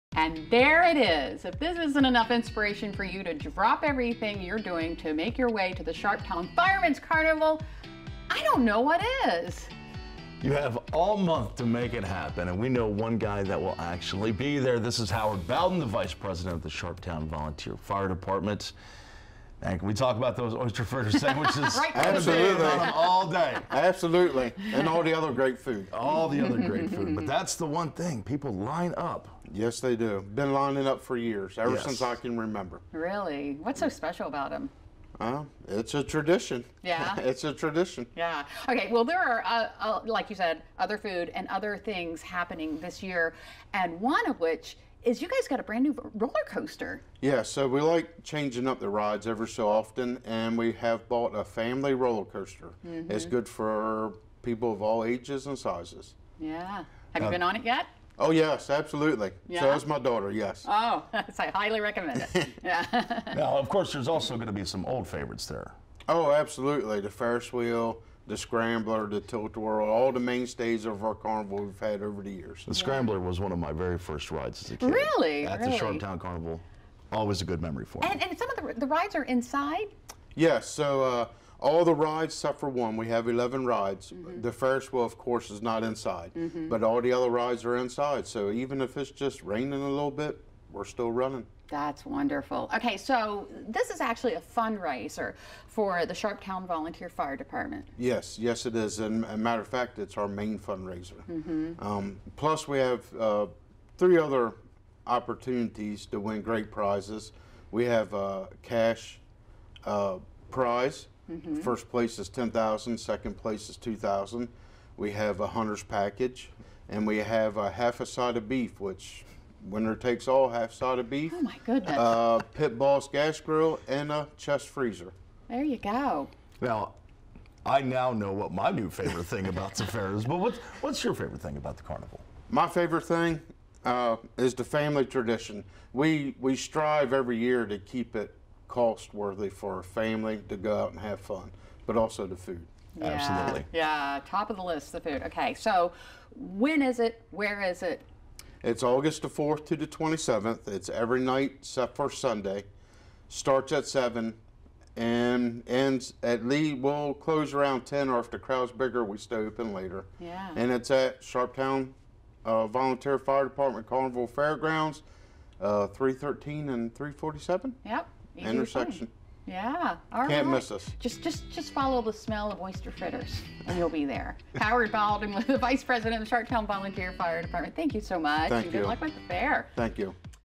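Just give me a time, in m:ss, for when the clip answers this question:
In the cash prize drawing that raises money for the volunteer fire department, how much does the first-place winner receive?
1:52.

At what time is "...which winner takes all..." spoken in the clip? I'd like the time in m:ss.
1:58.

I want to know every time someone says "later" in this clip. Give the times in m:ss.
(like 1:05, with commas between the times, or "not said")
2:39.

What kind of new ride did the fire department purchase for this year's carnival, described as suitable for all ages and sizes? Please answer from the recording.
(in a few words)
Family roller coaster.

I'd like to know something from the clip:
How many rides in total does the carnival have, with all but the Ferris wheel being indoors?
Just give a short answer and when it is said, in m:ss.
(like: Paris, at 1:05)
11, at 1:23.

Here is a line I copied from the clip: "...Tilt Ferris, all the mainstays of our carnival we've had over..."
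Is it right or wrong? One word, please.
wrong.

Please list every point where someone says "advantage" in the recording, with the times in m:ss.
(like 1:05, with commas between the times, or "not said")
not said.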